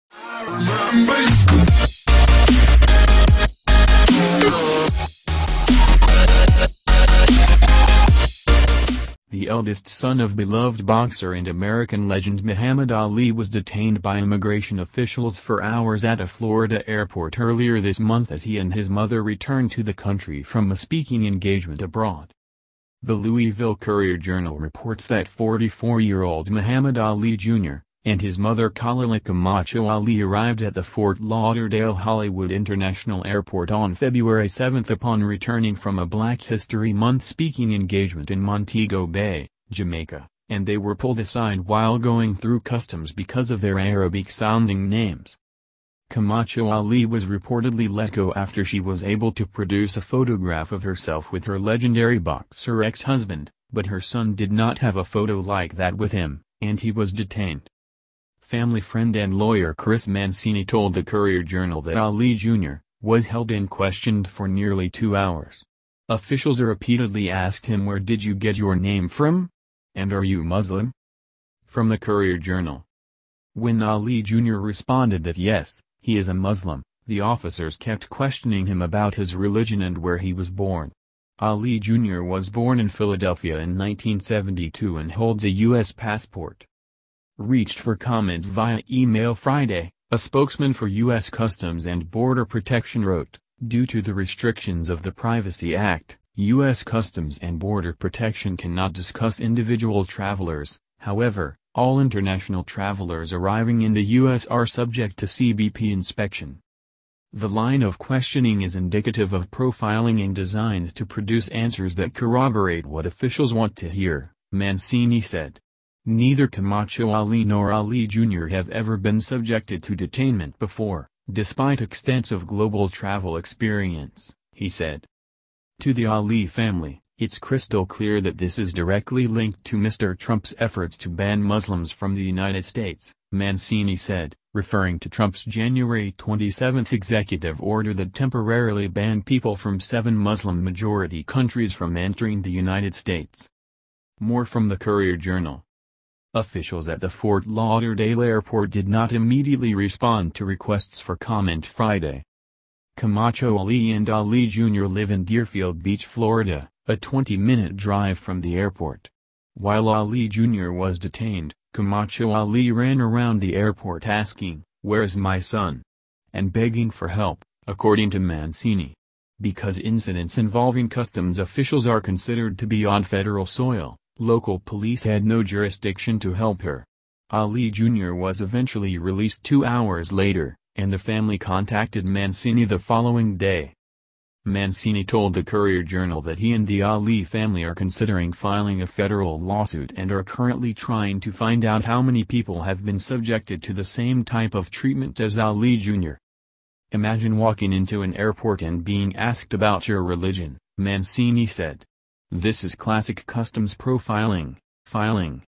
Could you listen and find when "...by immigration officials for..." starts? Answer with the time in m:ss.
0:14.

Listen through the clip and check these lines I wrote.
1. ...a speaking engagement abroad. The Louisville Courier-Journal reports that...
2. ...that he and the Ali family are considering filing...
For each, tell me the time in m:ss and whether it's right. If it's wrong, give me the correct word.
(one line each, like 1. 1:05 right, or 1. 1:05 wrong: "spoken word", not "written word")
1. 0:20 right
2. 3:06 right.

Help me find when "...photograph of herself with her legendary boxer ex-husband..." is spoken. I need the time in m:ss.
0:50.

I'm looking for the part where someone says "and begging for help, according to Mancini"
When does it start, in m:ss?
2:46.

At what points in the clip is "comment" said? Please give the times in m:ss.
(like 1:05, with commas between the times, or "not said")
1:27, 2:31.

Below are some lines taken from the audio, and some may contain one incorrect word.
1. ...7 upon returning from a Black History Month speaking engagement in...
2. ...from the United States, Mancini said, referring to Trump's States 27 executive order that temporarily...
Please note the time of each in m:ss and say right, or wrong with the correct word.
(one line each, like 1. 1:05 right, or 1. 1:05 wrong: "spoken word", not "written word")
1. 0:34 right
2. 2:11 wrong: "January", not "States".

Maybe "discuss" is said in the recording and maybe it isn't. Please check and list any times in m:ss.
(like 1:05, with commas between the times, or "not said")
1:38.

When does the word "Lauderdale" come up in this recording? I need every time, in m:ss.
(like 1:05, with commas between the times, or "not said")
0:31, 2:27.